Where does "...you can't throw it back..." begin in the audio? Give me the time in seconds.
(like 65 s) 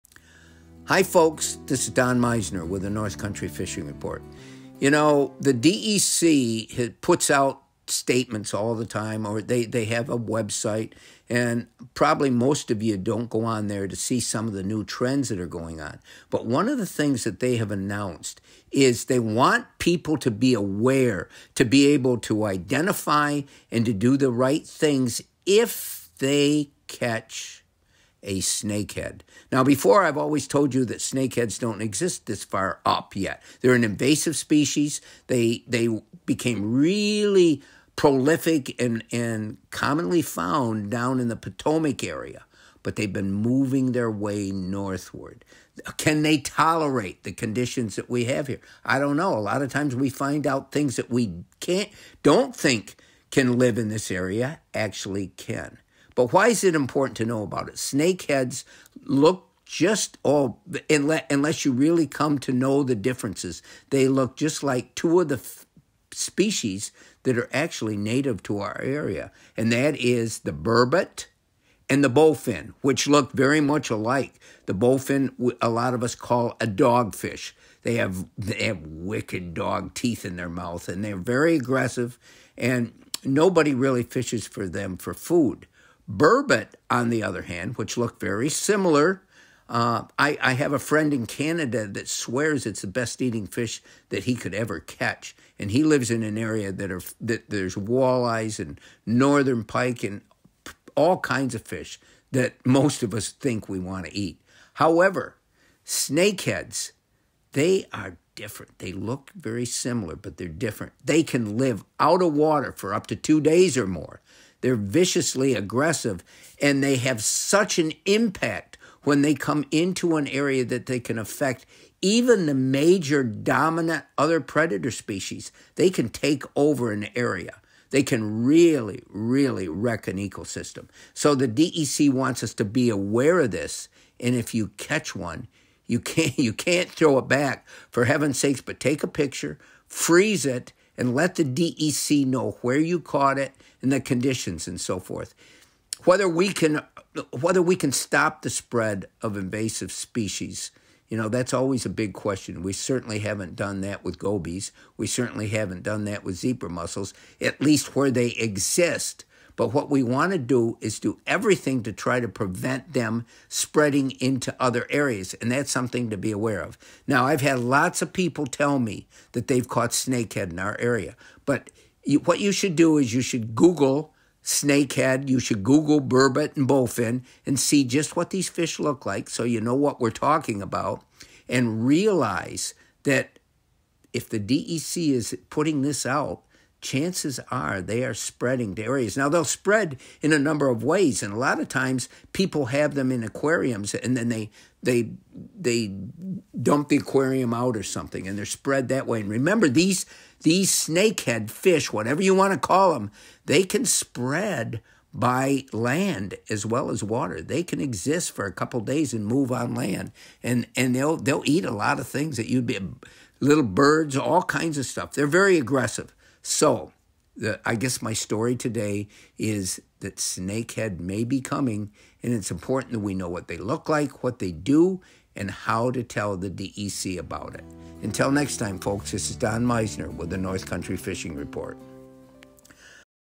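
136 s.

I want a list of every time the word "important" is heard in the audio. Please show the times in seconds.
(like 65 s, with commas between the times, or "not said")
56 s, 222 s.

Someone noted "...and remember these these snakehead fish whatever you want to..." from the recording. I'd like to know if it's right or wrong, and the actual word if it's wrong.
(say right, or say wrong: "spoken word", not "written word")
right.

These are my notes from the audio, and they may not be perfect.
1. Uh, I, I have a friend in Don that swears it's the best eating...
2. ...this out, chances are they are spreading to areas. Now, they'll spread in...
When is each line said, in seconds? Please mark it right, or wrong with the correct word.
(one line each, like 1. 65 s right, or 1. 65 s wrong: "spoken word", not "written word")
1. 89 s wrong: "Canada", not "Don"
2. 185 s right.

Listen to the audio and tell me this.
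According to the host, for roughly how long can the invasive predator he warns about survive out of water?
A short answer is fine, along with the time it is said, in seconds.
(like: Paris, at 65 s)
Up to 2 days or more, at 112 s.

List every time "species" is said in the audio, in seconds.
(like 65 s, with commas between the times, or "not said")
34 s, 66 s, 124 s, 149 s.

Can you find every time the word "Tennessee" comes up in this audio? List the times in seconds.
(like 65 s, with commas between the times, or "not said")
not said.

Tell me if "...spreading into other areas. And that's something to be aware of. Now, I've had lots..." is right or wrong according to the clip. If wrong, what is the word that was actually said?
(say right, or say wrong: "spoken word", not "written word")
right.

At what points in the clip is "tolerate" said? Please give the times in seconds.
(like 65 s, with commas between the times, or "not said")
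46 s.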